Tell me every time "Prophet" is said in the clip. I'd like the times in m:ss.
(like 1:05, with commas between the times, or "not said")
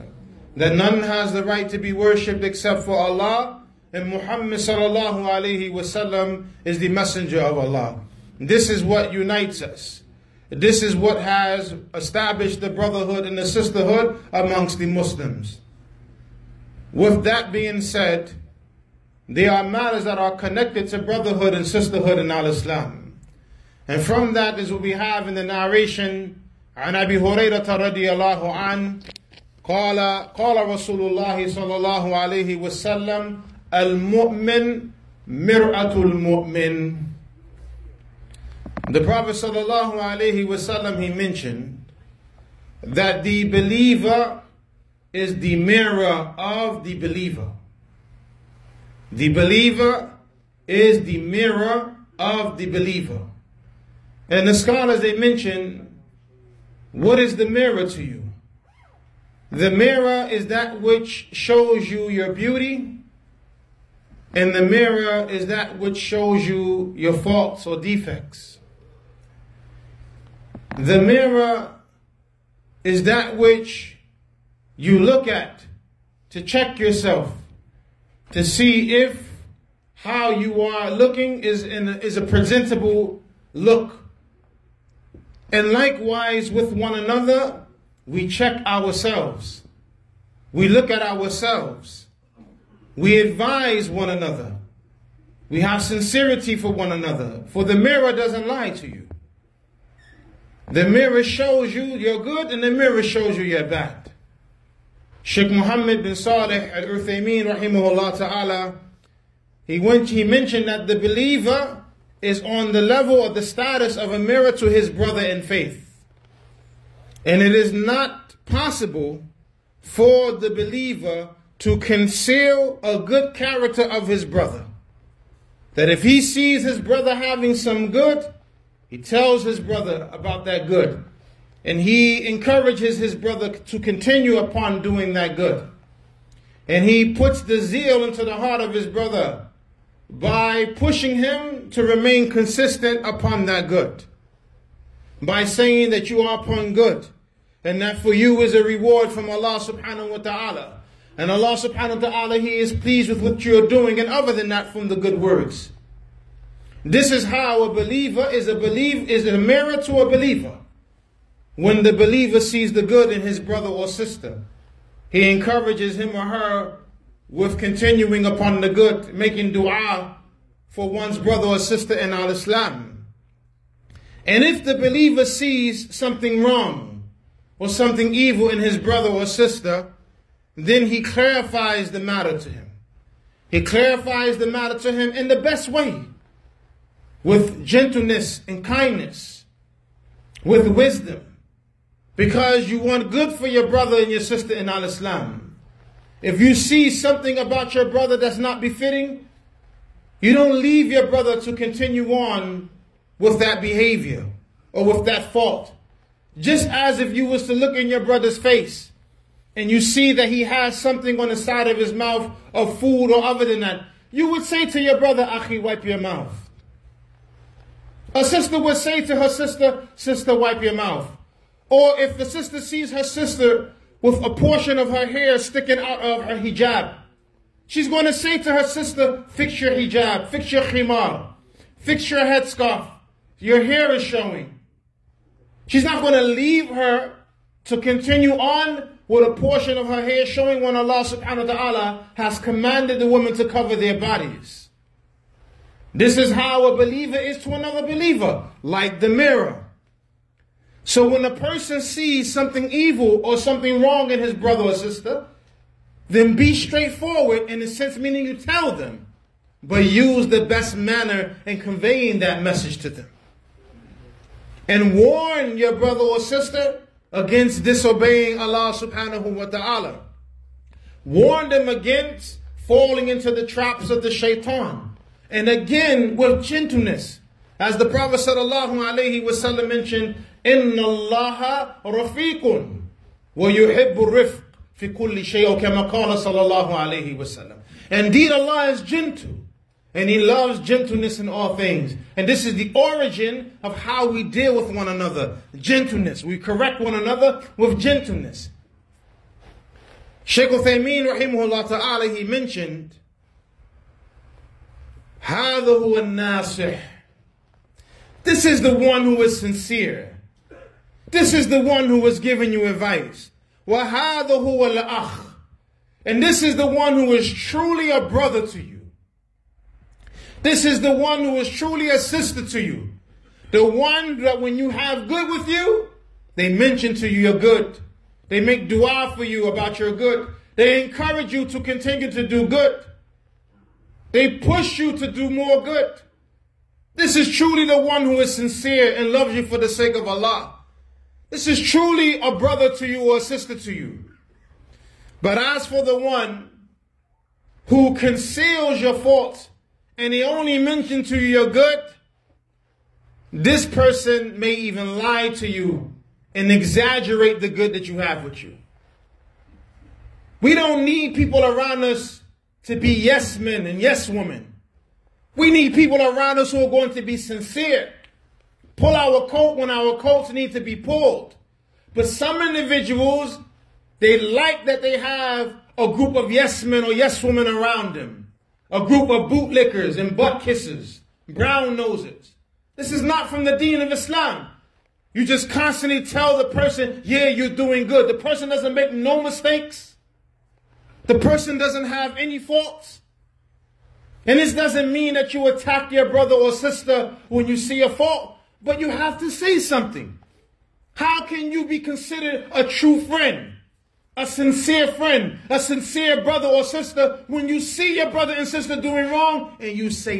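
0:39, 4:37.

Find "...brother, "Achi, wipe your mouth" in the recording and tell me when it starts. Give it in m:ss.
3:34.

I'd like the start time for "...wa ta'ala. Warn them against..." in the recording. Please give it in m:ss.
4:29.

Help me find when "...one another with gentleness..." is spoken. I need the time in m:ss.
4:56.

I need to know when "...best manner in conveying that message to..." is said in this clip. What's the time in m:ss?
4:20.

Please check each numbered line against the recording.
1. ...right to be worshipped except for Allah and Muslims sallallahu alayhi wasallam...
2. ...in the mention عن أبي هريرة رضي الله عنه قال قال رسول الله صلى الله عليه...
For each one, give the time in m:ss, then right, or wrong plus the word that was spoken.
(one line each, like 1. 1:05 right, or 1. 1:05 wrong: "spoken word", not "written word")
1. 0:01 wrong: "Muhammad", not "Muslims"
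2. 0:25 wrong: "narration", not "mention".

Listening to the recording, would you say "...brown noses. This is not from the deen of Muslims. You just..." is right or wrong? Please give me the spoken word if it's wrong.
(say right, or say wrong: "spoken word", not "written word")
wrong: "Islam", not "Muslims".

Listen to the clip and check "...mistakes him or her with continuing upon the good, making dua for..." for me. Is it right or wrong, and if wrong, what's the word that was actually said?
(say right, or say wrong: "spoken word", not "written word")
wrong: "encourages", not "mistakes".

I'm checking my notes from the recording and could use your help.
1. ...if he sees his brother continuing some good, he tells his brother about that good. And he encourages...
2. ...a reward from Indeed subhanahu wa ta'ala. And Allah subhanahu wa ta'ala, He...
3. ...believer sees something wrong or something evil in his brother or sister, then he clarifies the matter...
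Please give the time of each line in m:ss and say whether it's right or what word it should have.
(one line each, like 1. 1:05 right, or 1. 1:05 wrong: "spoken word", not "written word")
1. 2:05 wrong: "having", not "continuing"
2. 2:28 wrong: "Allah", not "Indeed"
3. 2:54 right.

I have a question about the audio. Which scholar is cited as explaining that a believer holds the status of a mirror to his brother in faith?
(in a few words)
Muhammad bin Saleh al-Uthaymeen.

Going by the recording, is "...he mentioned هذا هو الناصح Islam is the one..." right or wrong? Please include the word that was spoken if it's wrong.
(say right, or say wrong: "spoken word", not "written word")
wrong: "This", not "Islam".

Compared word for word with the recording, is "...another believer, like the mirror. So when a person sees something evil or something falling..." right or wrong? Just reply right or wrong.
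wrong.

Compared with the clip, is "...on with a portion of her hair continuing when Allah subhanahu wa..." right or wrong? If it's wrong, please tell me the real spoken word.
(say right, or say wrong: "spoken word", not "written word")
wrong: "showing", not "continuing".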